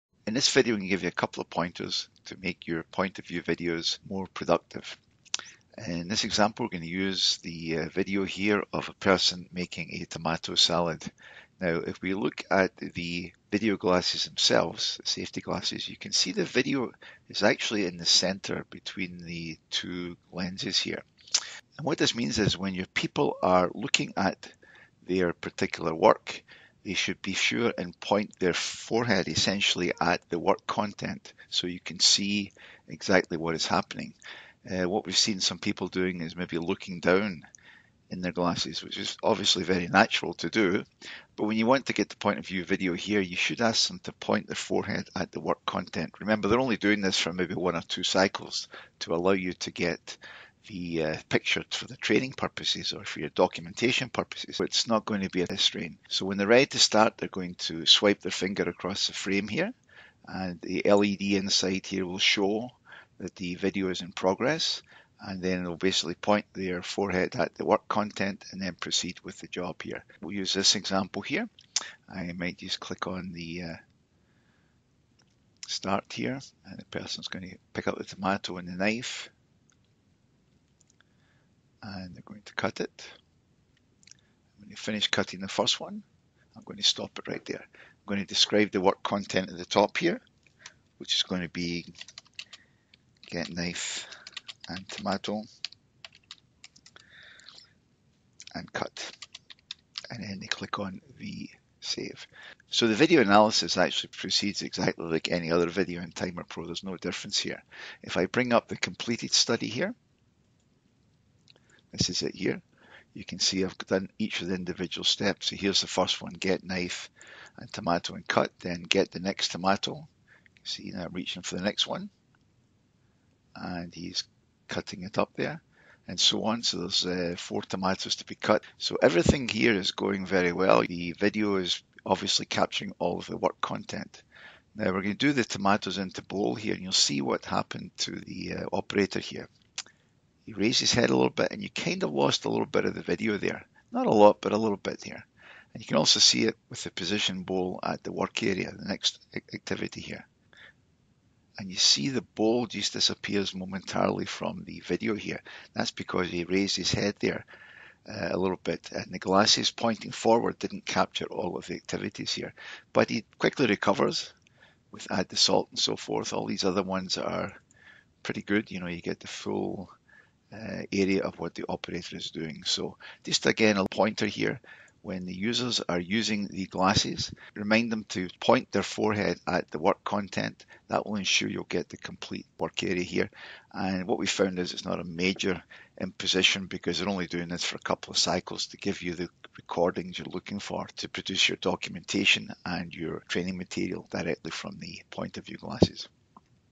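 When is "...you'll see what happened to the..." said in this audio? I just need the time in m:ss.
2:16.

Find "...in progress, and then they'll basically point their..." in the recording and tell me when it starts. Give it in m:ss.
1:04.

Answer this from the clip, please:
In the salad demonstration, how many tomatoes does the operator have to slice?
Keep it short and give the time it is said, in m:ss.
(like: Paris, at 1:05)
4, at 2:07.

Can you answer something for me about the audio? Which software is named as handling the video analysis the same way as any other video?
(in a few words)
Timer Pro.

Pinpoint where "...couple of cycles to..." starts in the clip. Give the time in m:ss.
3:07.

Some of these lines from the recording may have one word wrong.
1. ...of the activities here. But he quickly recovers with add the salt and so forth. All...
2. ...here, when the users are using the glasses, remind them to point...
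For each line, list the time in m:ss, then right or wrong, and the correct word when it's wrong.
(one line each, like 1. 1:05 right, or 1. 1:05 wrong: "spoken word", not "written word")
1. 2:41 right
2. 2:54 right.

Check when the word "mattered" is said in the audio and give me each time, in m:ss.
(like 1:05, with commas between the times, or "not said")
not said.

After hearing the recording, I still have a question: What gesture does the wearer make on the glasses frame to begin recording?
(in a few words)
Swipe their finger.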